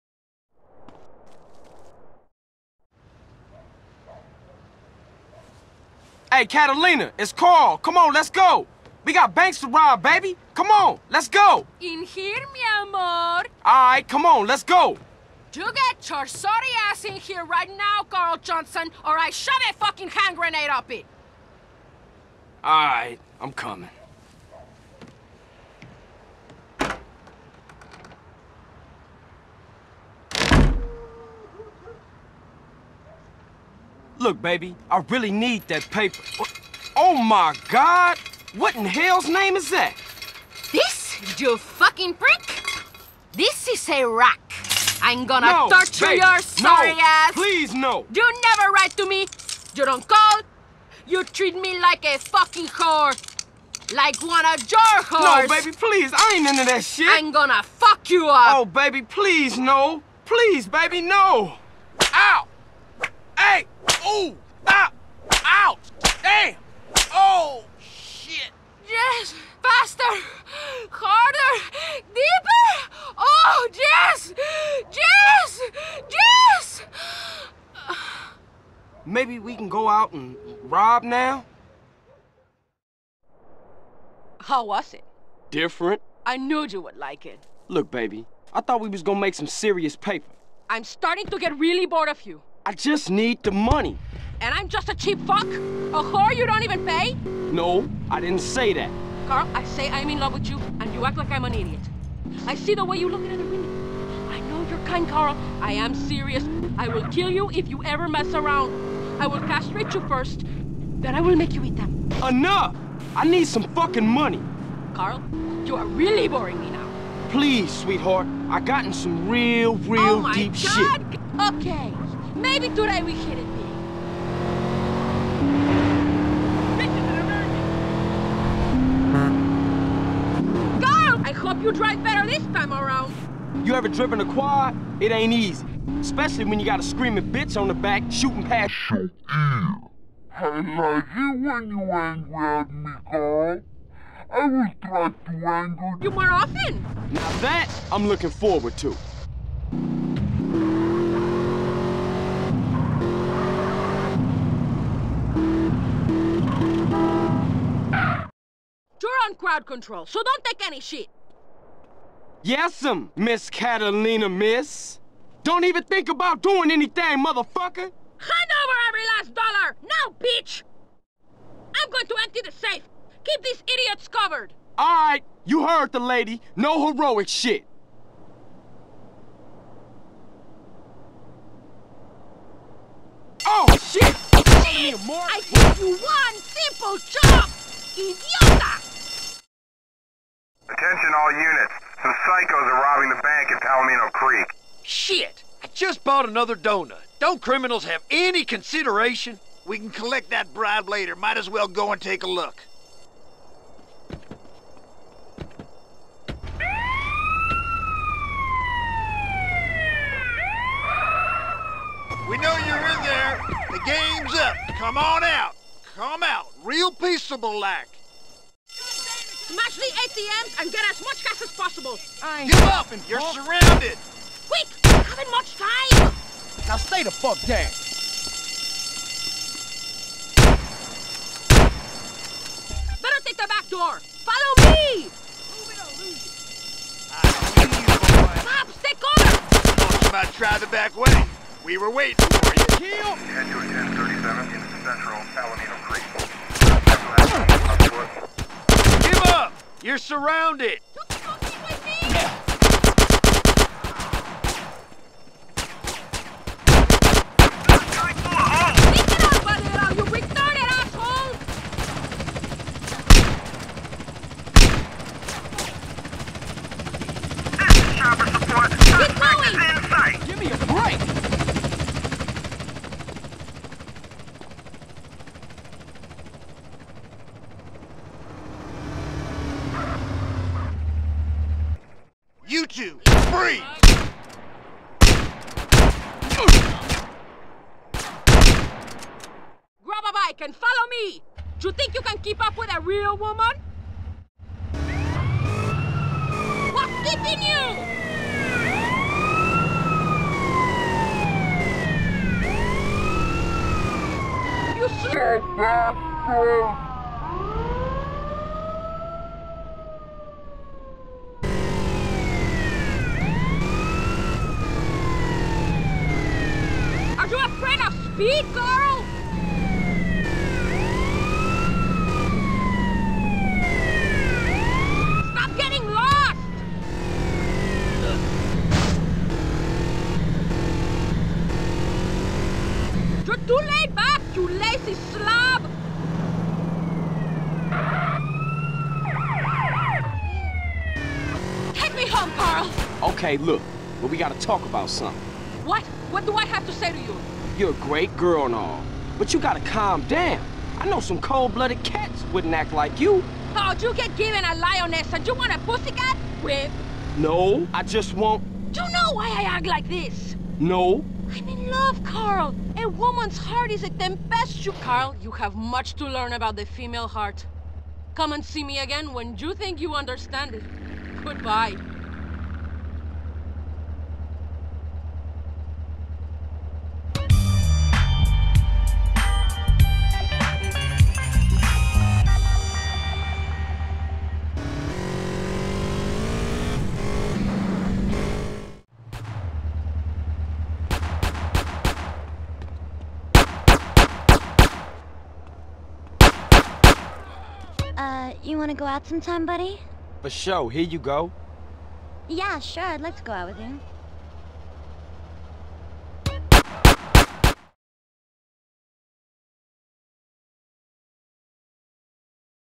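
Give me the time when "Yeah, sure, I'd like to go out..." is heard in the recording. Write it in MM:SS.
06:42.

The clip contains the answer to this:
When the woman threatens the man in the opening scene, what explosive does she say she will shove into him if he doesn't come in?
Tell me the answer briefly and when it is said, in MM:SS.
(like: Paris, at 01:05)
Hand grenade, at 00:20.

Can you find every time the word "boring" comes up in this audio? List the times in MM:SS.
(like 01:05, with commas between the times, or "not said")
01:56.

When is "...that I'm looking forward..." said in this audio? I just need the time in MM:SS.
02:27.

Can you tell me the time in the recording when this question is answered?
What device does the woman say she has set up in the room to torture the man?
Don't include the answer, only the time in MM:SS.
00:43.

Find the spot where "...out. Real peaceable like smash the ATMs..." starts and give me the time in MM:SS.
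03:36.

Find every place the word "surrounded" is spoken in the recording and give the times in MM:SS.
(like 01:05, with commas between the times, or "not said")
03:43, 04:09.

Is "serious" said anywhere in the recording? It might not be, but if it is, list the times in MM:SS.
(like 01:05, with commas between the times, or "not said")
01:29, 01:45.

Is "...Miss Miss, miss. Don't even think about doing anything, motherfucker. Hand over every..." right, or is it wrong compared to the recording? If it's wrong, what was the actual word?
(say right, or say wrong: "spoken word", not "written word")
wrong: "Catalina", not "Miss".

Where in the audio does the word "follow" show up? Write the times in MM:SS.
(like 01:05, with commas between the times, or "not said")
03:53, 04:50.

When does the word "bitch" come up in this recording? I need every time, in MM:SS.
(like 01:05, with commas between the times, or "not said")
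02:17, 02:50.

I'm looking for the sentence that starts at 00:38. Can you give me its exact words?
What in hell's name is that?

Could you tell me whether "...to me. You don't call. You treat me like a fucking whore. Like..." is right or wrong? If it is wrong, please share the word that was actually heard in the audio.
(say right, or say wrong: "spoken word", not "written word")
right.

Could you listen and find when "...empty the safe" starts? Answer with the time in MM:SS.
02:52.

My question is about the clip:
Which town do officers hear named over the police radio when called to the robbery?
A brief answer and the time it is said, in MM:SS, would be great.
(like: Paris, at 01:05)
Palomino Creek, at 03:13.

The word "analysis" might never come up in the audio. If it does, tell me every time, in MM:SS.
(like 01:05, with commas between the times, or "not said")
not said.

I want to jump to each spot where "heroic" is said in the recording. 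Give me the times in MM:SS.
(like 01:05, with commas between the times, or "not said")
02:56.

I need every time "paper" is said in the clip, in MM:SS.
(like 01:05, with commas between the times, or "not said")
00:35, 01:29.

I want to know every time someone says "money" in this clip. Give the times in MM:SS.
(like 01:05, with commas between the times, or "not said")
01:33, 01:54.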